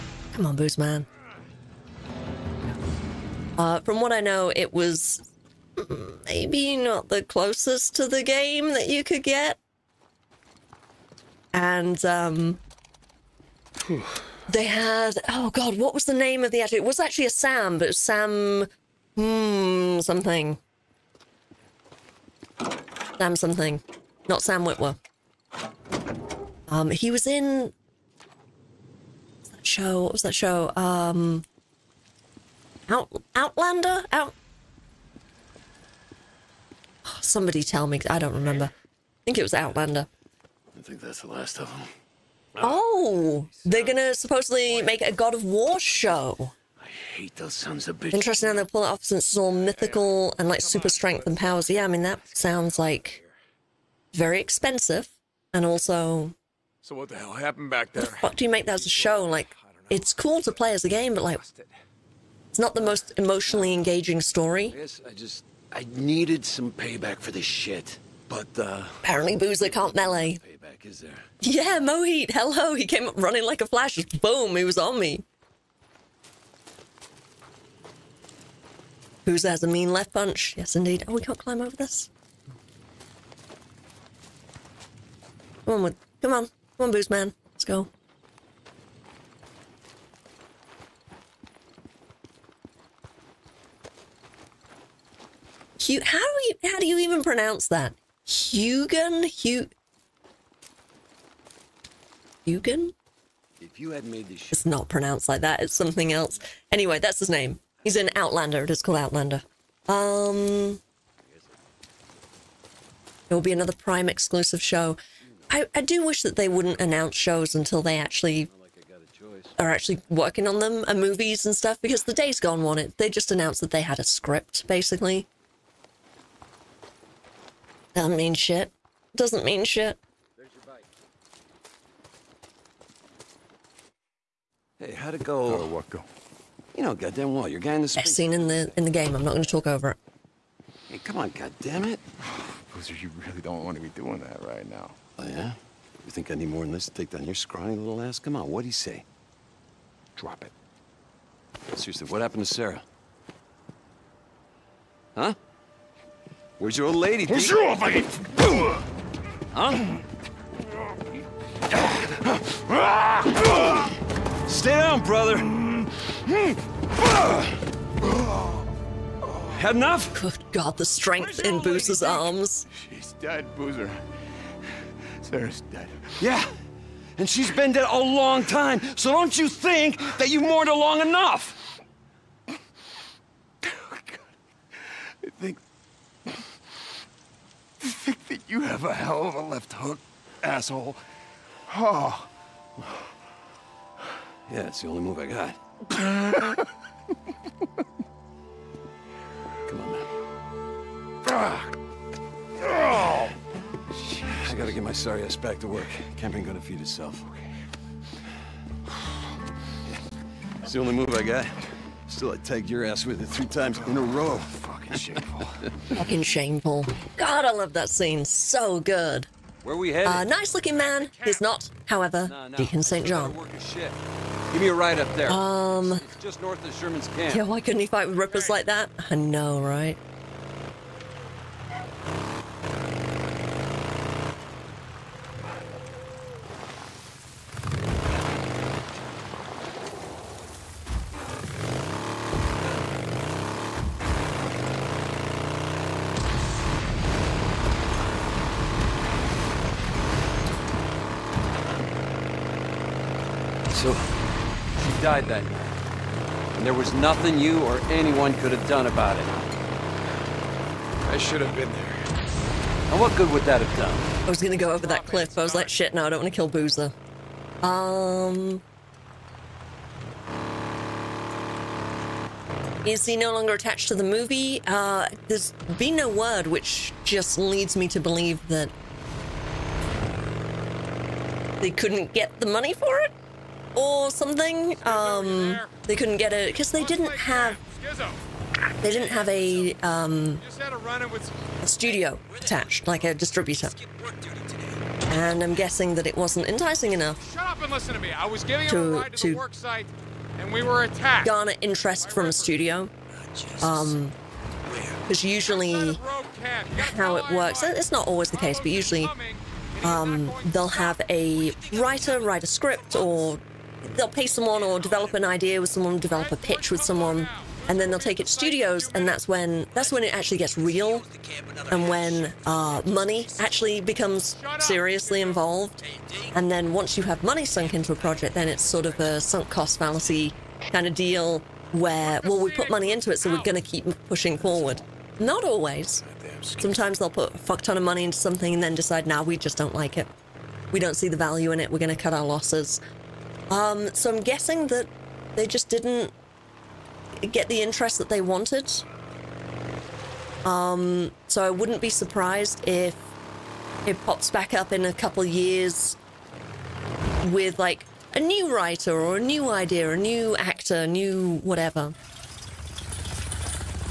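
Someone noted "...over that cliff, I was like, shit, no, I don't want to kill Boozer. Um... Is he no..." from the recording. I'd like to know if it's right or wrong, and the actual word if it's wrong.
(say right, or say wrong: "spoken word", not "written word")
right.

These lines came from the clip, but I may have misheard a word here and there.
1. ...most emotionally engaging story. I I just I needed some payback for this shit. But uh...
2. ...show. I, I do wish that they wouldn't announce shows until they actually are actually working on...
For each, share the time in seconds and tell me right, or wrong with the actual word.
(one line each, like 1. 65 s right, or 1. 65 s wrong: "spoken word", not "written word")
1. 62 s right
2. 114 s right.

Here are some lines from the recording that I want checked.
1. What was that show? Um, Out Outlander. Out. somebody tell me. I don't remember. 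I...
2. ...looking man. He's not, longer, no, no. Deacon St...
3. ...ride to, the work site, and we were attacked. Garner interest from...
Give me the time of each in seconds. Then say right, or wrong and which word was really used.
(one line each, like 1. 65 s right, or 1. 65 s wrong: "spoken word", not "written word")
1. 30 s right
2. 220 s wrong: "however", not "longer"
3. 299 s right.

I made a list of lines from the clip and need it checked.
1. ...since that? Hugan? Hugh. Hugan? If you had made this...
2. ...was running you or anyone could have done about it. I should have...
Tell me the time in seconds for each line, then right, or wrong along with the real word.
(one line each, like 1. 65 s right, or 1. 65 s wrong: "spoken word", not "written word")
1. 97 s wrong: "pronounce", not "since"
2. 256 s wrong: "nothing", not "running".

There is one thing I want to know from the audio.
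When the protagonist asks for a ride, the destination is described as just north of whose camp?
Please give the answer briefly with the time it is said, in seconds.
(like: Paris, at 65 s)
Sherman's camp, at 226 s.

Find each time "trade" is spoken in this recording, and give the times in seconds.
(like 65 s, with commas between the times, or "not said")
not said.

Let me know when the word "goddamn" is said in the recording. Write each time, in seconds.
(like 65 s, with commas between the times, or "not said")
136 s, 141 s.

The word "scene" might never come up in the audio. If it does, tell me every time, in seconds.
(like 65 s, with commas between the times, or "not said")
137 s, 217 s.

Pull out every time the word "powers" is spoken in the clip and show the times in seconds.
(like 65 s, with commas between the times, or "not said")
51 s.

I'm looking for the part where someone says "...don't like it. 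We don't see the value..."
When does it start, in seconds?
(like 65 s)
339 s.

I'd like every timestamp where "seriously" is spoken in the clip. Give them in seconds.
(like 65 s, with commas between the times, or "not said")
151 s, 324 s.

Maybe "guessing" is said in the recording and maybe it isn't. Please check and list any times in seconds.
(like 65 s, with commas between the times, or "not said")
295 s, 344 s.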